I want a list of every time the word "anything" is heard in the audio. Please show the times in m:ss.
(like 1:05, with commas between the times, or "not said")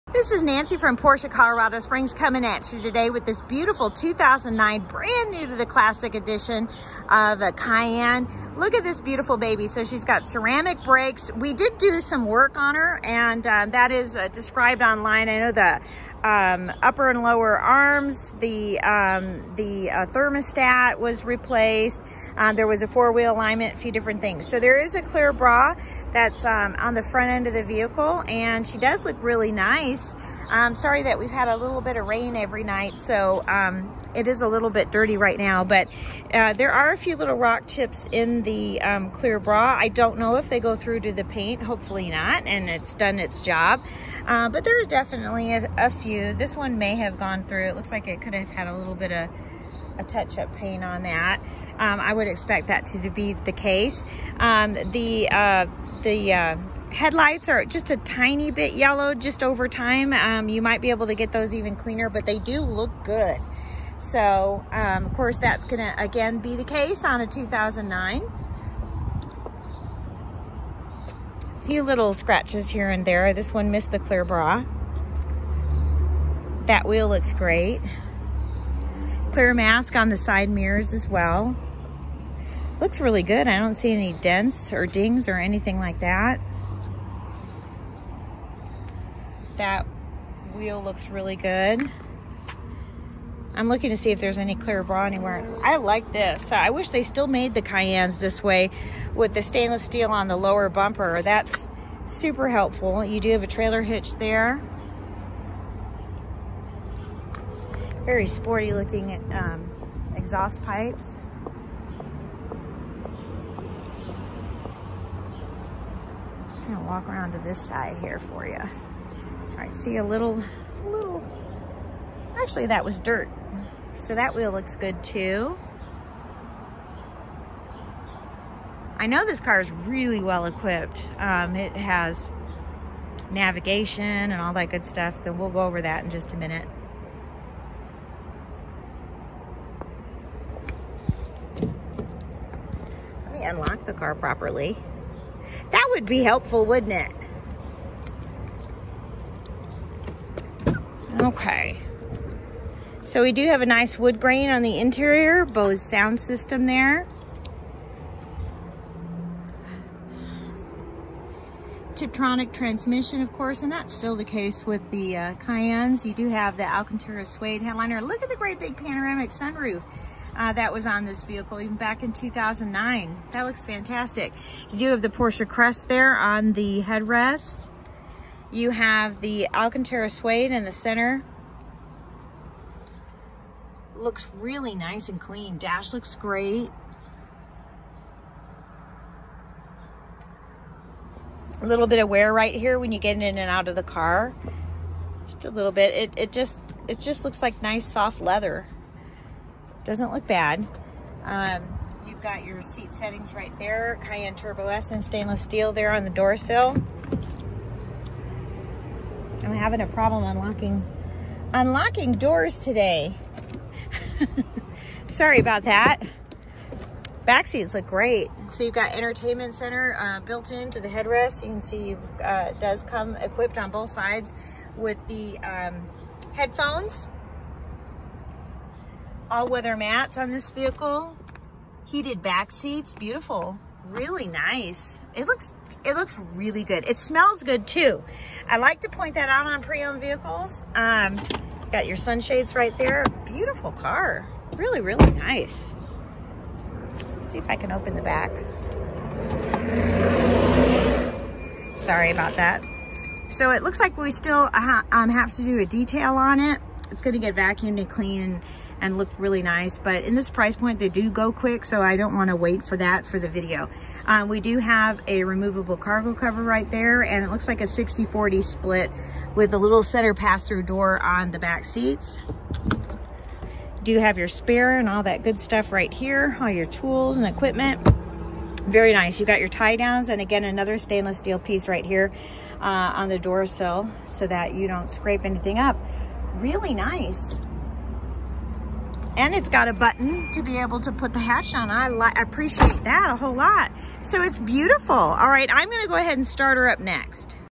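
1:25, 4:45.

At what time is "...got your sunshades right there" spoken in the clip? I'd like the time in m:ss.
4:01.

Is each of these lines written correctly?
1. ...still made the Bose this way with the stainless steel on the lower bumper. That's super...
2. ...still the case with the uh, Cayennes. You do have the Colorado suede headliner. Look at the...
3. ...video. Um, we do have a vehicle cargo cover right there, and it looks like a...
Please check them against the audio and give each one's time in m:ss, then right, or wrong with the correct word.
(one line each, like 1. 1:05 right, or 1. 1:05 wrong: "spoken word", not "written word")
1. 1:37 wrong: "Cayennes", not "Bose"
2. 2:43 wrong: "Alcantara", not "Colorado"
3. 4:23 wrong: "removable", not "vehicle".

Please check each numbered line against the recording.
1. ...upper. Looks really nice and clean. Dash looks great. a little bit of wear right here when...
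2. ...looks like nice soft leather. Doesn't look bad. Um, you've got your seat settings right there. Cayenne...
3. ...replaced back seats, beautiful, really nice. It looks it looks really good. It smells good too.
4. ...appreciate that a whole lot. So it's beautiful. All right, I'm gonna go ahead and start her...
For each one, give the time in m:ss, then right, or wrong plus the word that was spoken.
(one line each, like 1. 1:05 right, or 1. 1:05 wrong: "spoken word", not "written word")
1. 3:00 wrong: "center", not "upper"
2. 3:17 right
3. 3:51 wrong: "heated", not "replaced"
4. 4:52 right.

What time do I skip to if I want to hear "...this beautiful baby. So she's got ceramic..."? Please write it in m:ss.
0:08.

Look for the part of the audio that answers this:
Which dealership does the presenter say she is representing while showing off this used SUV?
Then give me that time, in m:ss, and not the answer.
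0:00.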